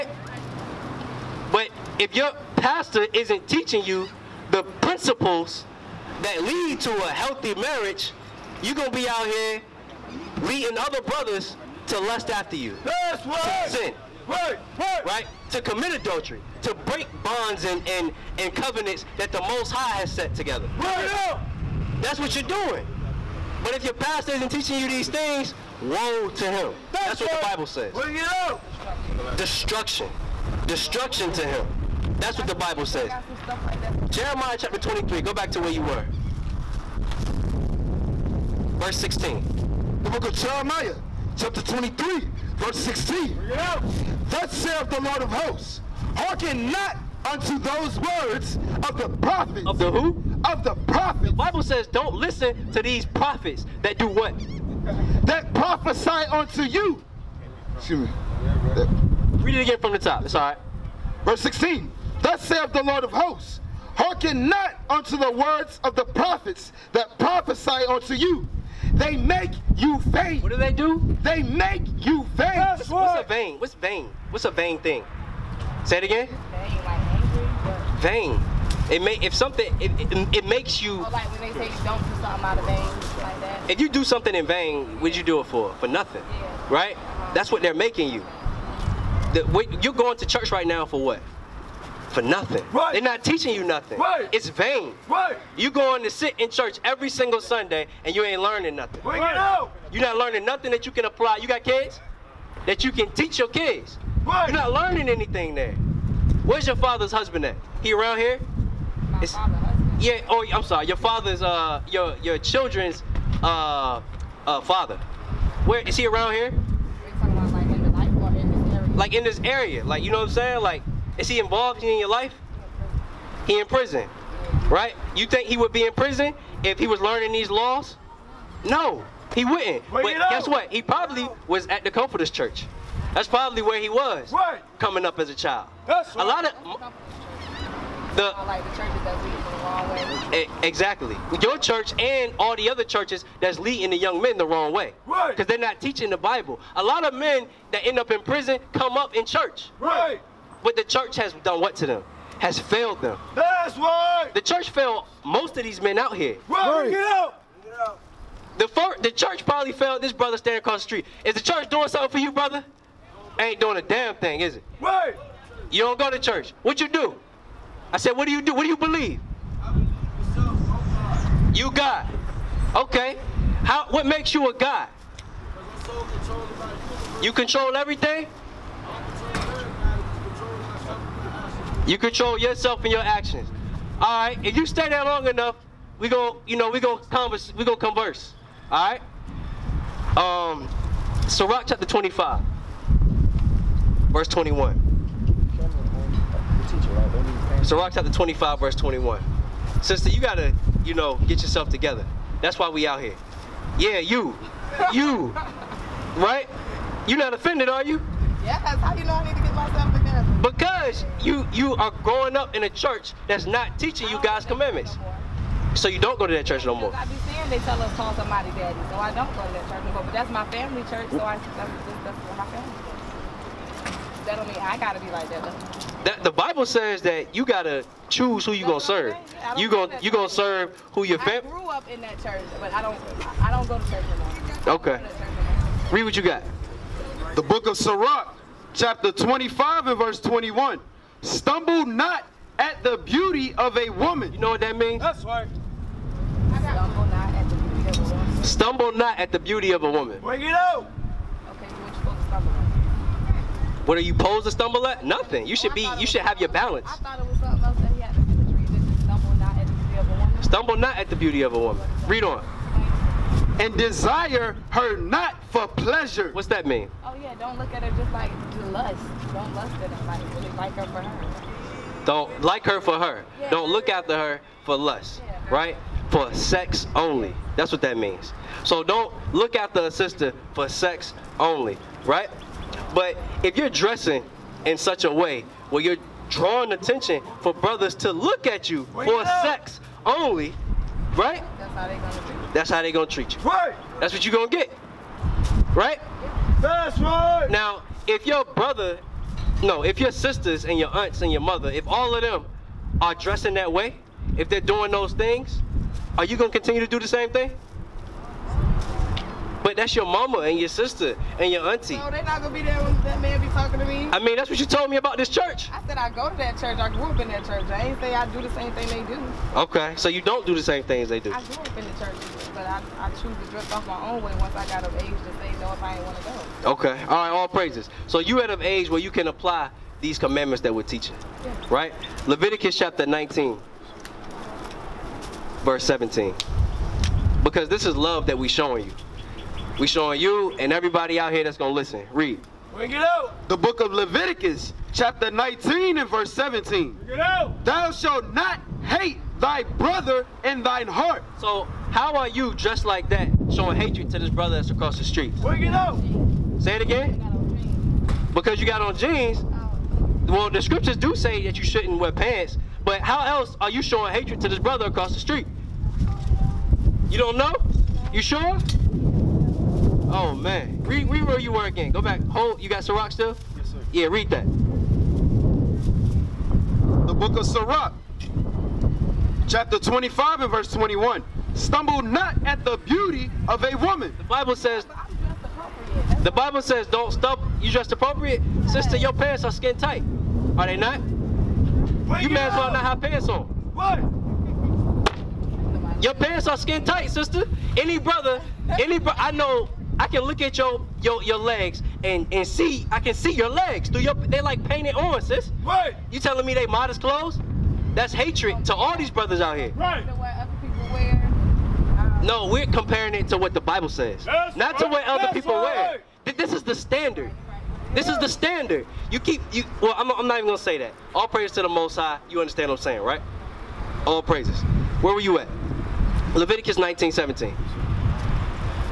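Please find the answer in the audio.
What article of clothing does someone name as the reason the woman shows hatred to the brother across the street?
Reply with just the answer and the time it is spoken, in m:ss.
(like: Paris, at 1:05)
Jeans, at 5:58.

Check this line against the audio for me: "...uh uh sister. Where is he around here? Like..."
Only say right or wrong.
wrong.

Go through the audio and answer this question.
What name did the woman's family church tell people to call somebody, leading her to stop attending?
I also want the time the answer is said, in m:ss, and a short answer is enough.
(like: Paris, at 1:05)
Daddy, at 3:37.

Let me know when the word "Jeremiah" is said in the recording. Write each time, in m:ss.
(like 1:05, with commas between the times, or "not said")
0:34, 0:40.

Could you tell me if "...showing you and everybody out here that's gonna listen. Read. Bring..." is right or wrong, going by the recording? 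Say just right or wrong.
right.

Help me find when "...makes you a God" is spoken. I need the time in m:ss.
2:54.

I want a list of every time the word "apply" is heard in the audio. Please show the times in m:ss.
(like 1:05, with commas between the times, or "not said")
1:41, 5:29.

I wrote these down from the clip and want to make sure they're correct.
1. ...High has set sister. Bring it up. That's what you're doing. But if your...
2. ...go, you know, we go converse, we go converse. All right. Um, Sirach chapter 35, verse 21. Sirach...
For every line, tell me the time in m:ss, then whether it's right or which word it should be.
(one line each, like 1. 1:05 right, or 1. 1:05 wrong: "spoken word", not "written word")
1. 0:19 wrong: "together", not "sister"
2. 3:06 wrong: "25", not "35".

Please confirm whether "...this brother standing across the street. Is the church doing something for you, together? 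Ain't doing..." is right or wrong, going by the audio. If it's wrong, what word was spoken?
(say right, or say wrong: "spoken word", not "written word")
wrong: "brother", not "together".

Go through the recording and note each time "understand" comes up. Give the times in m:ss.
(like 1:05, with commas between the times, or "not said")
7:02.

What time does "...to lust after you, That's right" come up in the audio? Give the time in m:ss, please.
0:11.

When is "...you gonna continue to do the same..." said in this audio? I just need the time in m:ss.
5:06.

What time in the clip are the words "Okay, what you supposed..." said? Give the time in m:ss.
4:11.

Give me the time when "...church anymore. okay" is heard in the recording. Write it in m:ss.
3:53.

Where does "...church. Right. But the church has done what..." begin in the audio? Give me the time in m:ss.
2:29.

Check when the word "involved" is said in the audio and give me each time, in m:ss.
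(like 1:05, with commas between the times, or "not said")
2:01.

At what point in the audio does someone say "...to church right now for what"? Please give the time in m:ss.
1:30.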